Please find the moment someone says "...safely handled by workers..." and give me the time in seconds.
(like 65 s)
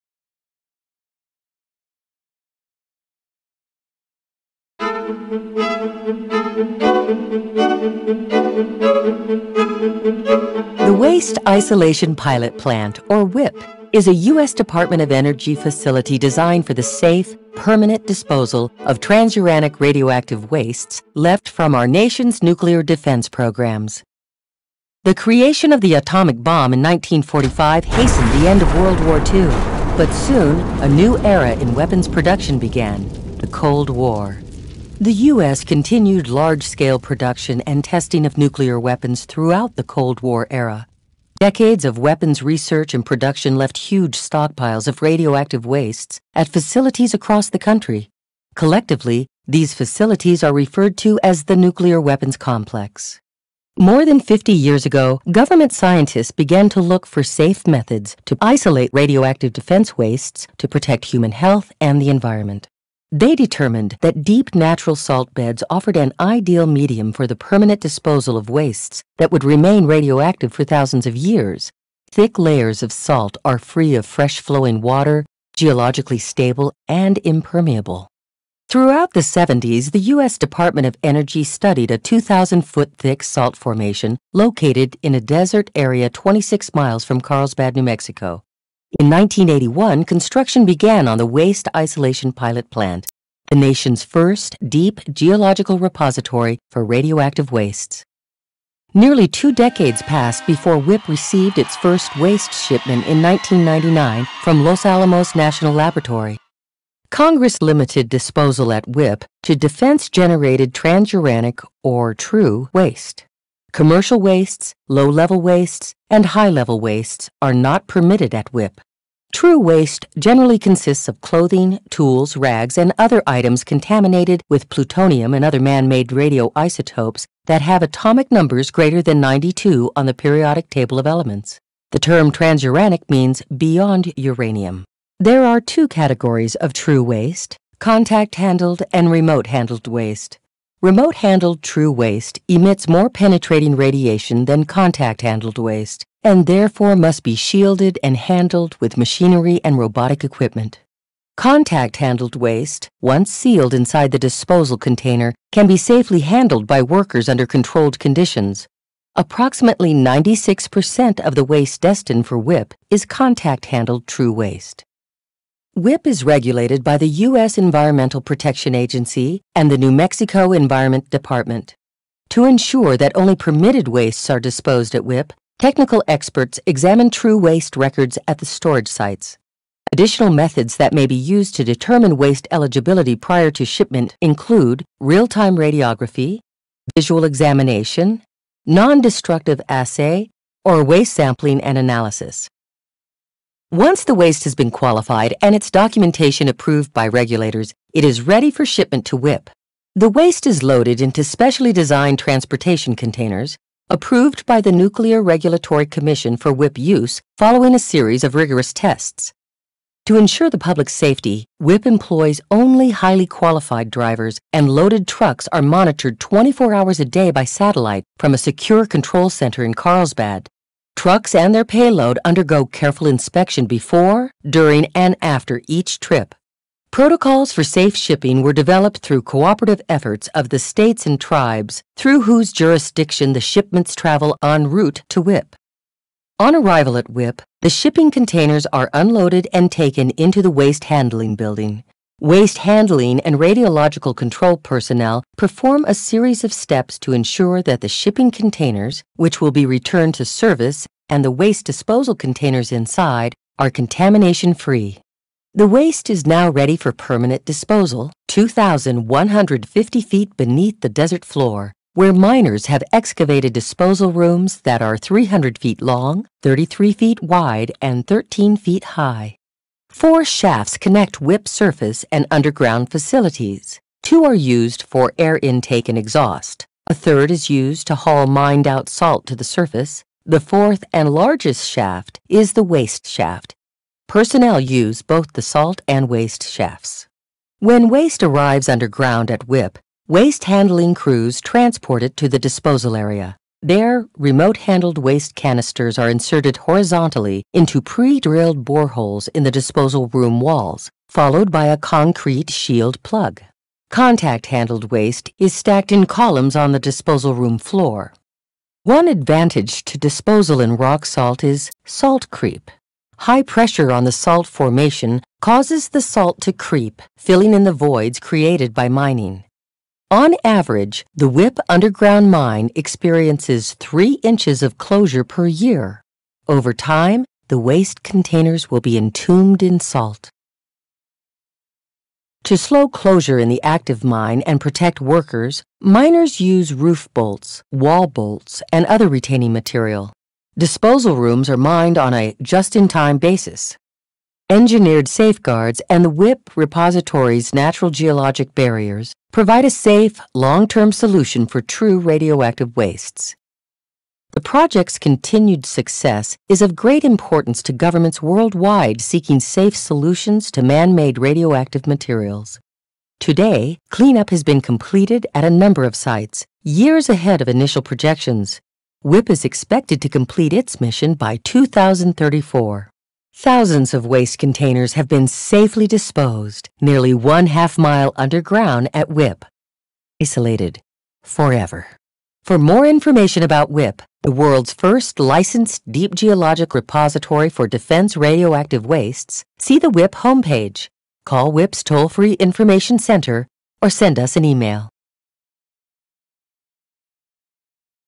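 155 s.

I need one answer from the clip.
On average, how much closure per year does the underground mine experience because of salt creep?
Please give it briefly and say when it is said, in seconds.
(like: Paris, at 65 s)
3 inches, at 323 s.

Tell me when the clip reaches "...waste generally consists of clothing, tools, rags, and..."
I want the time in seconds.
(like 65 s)
119 s.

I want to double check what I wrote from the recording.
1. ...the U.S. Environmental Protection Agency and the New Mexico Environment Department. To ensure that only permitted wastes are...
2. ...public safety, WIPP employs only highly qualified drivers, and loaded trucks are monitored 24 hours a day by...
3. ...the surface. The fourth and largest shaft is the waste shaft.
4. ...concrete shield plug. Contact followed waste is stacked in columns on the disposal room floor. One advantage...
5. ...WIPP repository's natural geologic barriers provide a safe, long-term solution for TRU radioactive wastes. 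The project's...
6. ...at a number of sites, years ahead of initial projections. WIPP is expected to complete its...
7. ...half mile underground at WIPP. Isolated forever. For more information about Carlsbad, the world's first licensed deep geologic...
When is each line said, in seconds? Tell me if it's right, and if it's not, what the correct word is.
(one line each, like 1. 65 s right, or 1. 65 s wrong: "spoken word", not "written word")
1. 166 s right
2. 210 s right
3. 279 s right
4. 301 s wrong: "handled", not "followed"
5. 346 s right
6. 365 s right
7. 377 s wrong: "WIPP", not "Carlsbad".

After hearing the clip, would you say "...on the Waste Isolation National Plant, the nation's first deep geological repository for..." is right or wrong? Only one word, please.
wrong.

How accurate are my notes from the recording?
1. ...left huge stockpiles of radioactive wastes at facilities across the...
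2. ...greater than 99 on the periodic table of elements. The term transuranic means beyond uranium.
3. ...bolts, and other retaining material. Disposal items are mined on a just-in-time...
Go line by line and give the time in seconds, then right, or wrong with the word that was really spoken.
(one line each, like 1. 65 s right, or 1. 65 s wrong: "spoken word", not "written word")
1. 43 s right
2. 128 s wrong: "92", not "99"
3. 338 s wrong: "rooms", not "items".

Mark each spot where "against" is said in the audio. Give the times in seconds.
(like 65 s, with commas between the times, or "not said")
not said.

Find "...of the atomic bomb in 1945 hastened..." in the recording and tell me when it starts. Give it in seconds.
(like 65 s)
25 s.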